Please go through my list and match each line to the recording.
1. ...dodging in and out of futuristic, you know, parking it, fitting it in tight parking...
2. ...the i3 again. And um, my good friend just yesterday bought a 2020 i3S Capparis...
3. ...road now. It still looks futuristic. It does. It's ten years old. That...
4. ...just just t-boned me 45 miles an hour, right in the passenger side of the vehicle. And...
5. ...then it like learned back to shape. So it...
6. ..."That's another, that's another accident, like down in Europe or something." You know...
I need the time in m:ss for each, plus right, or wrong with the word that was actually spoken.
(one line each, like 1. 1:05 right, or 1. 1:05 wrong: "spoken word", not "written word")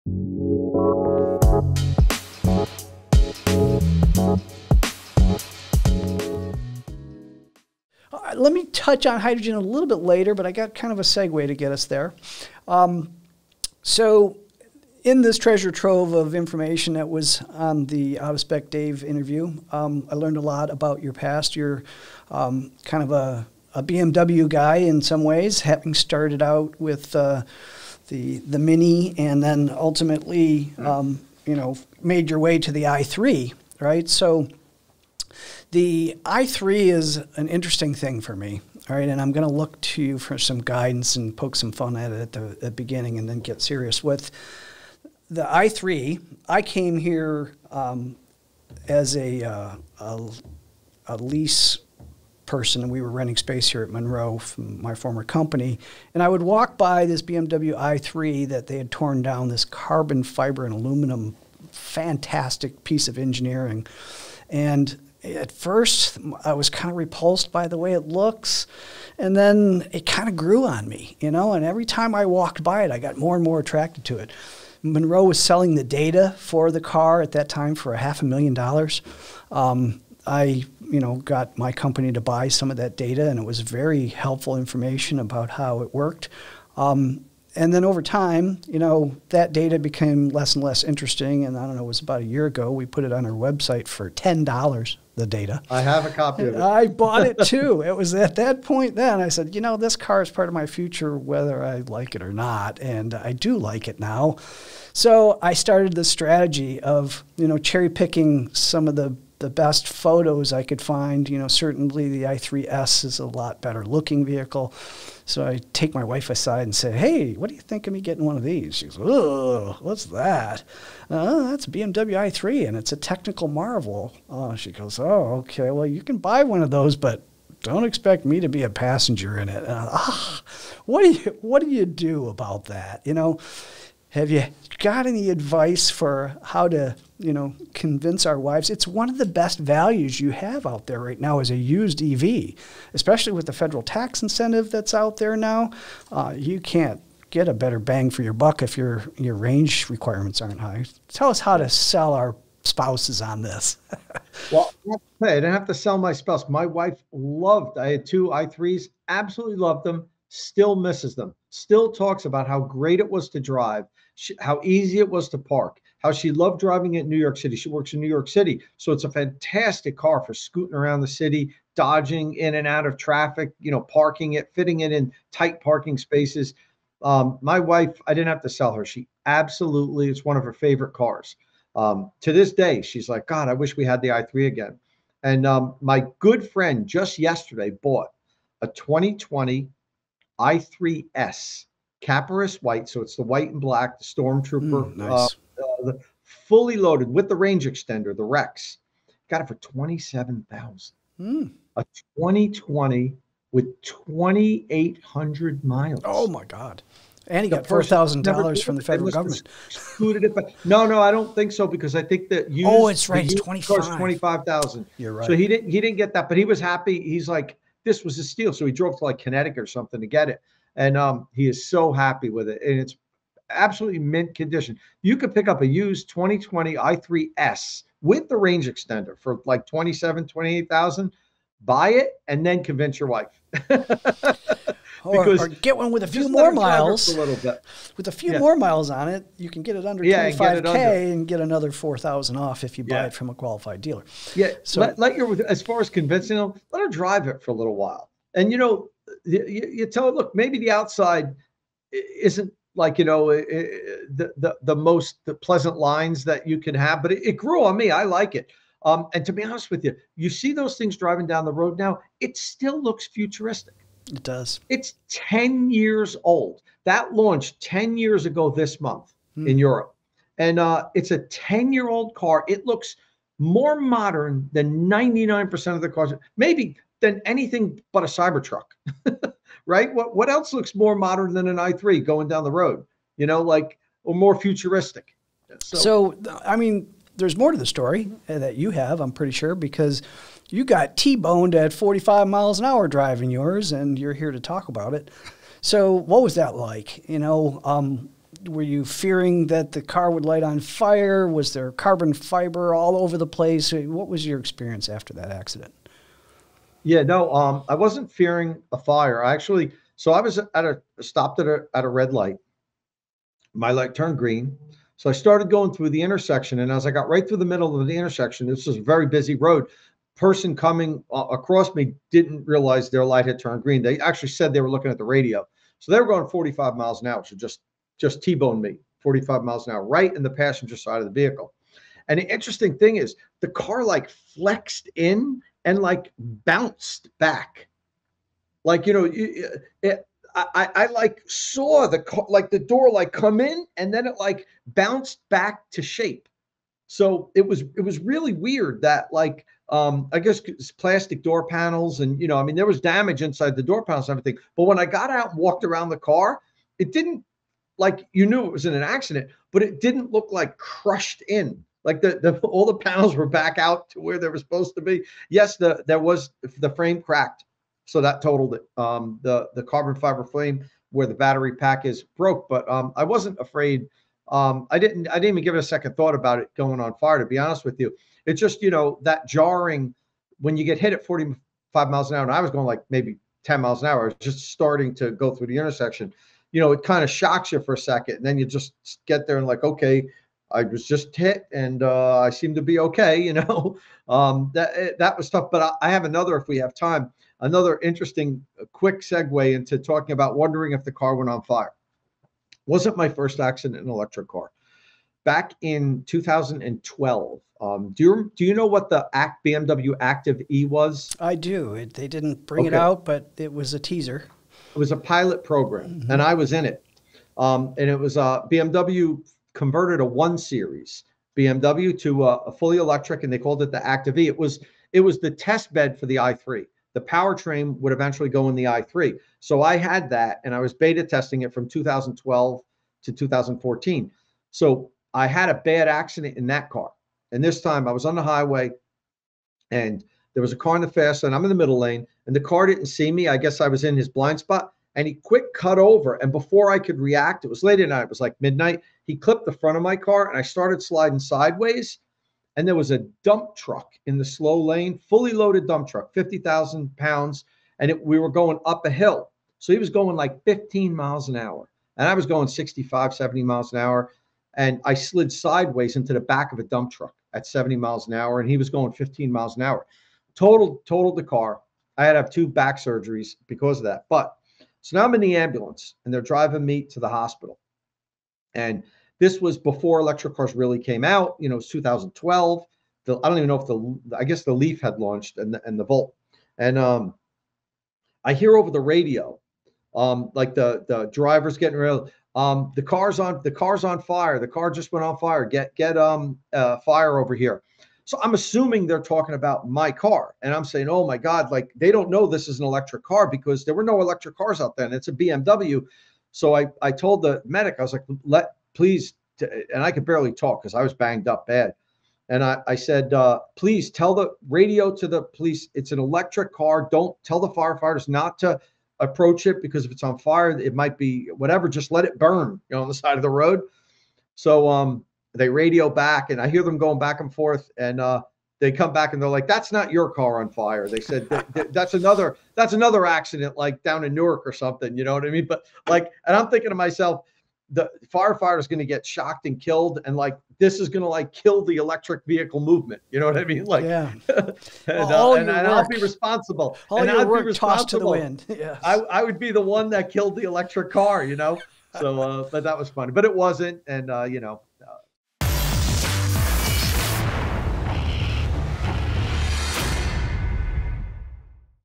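1. 2:51 wrong: "traffic", not "futuristic"
2. 3:04 right
3. 4:21 right
4. 5:27 right
5. 5:43 wrong: "bounced", not "learned"
6. 8:51 wrong: "Newark", not "Europe".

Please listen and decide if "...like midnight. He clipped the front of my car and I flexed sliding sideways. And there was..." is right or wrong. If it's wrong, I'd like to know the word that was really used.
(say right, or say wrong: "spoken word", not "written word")
wrong: "started", not "flexed".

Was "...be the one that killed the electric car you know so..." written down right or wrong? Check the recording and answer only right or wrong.
right.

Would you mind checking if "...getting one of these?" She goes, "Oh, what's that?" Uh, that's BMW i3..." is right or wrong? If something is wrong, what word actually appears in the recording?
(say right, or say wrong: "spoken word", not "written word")
right.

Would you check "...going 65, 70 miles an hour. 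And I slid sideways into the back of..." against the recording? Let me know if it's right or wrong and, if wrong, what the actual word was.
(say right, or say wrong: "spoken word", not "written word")
right.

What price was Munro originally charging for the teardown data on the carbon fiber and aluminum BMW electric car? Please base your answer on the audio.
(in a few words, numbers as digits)
half a million dollars.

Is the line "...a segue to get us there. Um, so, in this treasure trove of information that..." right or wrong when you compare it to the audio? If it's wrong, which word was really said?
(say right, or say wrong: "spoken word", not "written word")
right.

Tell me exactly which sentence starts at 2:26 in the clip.
Uh, you can't get a better bang for your buck if your your range requirements aren't high.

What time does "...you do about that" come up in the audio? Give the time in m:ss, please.
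2:11.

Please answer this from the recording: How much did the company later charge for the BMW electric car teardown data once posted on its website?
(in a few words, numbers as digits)
$10.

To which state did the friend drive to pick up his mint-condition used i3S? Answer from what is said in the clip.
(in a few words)
Connecticut.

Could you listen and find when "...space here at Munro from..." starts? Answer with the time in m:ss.
0:53.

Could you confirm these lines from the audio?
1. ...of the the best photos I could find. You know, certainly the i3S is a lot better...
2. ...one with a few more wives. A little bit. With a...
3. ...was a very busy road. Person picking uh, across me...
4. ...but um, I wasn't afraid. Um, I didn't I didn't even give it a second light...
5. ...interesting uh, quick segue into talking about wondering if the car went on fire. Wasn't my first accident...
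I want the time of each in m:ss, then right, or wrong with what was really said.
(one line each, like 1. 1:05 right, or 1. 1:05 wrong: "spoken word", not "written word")
1. 1:48 right
2. 3:55 wrong: "miles", not "wives"
3. 5:18 wrong: "coming", not "picking"
4. 6:12 wrong: "thought", not "light"
5. 6:37 right.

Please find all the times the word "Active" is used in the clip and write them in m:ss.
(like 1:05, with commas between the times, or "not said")
6:49, 7:03.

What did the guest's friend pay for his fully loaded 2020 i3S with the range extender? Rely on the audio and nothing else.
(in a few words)
$27,000.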